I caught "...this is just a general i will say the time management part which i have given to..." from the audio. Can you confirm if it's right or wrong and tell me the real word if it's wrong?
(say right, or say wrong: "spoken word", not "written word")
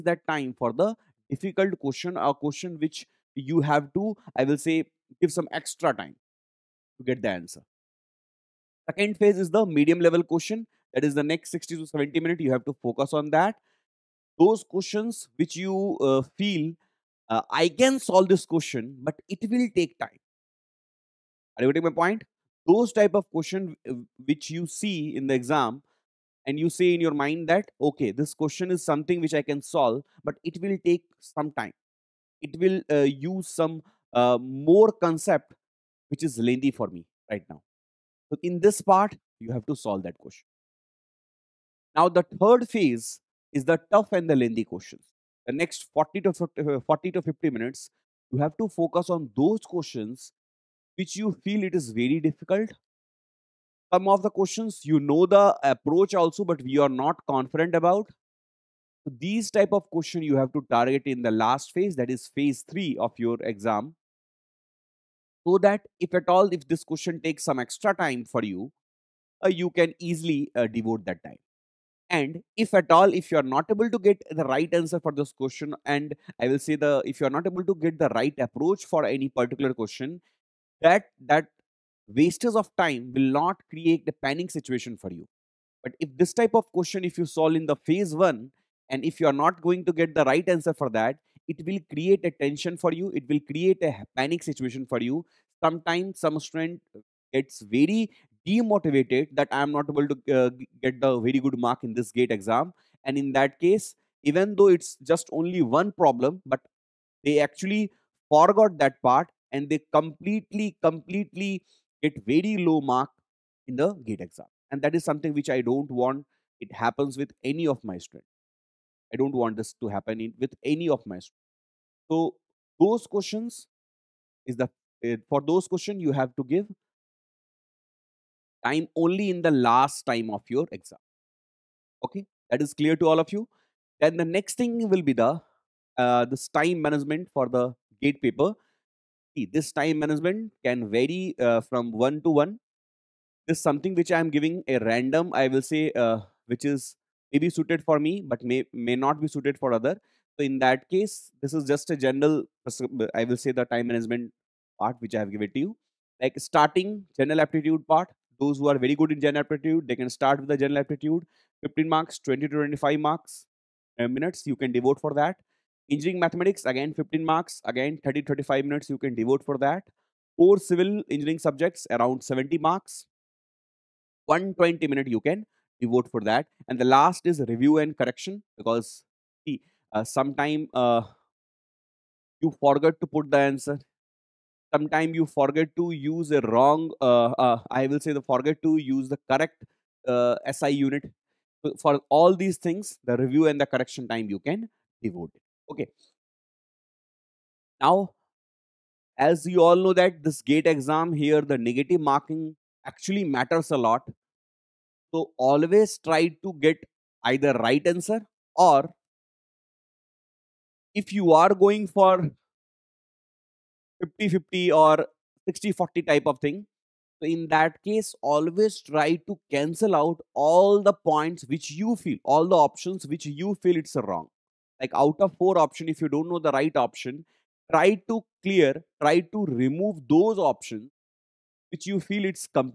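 right.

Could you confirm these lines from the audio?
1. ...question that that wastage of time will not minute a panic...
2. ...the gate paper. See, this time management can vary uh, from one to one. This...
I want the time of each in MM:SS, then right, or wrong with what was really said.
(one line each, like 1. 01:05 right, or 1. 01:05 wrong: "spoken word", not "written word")
1. 01:19 wrong: "create", not "minute"
2. 02:17 right.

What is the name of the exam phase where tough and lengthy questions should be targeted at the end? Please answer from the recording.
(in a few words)
phase 3.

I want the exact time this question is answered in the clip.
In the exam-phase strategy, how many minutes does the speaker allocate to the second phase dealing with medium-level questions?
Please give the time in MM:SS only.
00:11.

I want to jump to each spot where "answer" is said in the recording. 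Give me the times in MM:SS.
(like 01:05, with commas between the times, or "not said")
00:07, 01:14, 01:30, 03:03, 03:27.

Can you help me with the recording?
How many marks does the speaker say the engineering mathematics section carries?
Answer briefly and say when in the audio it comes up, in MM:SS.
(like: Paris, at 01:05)
15, at 02:46.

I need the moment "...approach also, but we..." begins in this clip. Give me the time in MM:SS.
00:55.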